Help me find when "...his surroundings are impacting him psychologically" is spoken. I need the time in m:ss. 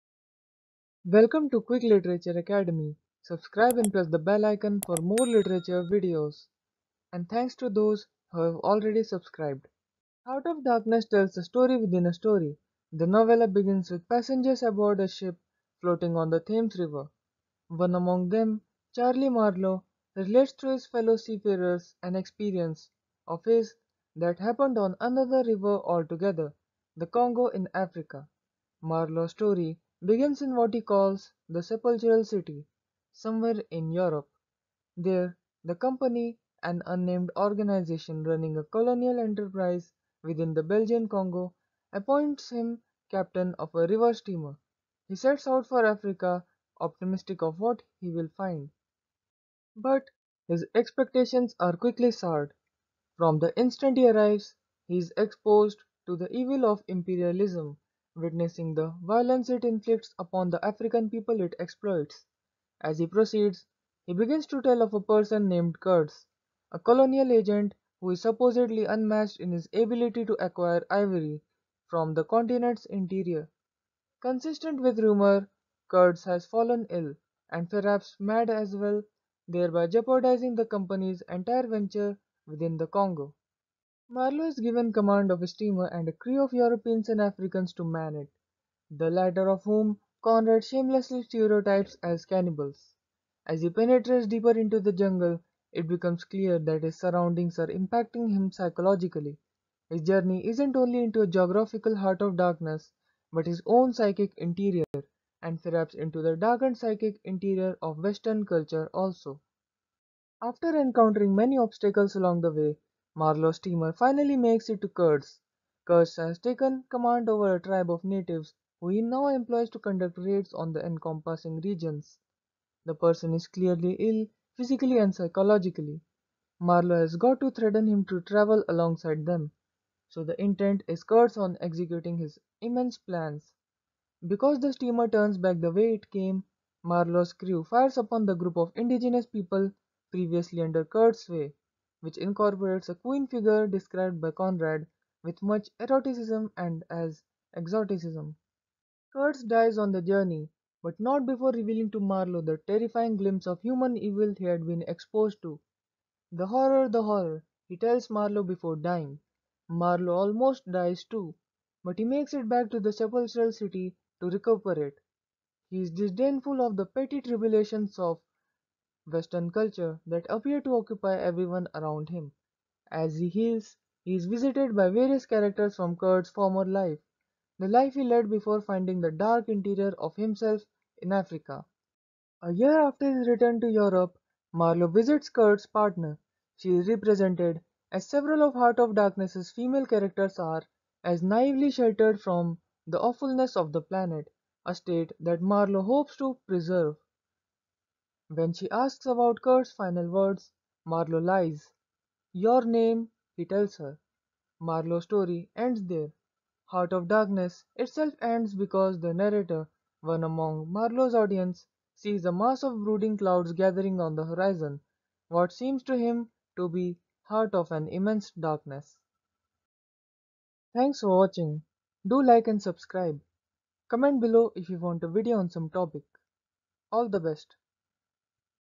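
1:36.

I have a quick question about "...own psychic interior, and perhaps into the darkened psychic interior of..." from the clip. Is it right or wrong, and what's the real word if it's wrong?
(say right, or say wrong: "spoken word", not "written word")
right.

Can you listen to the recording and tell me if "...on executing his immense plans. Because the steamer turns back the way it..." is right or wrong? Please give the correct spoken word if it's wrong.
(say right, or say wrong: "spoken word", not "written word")
right.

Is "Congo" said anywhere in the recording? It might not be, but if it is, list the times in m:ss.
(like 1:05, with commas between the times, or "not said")
0:27, 0:41, 1:22.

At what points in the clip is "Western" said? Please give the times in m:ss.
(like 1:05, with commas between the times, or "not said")
1:48, 2:49.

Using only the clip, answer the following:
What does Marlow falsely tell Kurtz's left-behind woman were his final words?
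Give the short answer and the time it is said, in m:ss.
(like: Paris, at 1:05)
Your name, at 3:22.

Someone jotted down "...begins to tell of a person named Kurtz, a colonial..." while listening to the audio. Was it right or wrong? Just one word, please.
right.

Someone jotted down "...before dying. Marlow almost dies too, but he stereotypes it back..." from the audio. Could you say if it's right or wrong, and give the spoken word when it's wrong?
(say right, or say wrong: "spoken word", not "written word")
wrong: "makes", not "stereotypes".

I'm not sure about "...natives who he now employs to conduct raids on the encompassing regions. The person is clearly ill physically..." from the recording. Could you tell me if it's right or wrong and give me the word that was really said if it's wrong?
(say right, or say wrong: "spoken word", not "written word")
right.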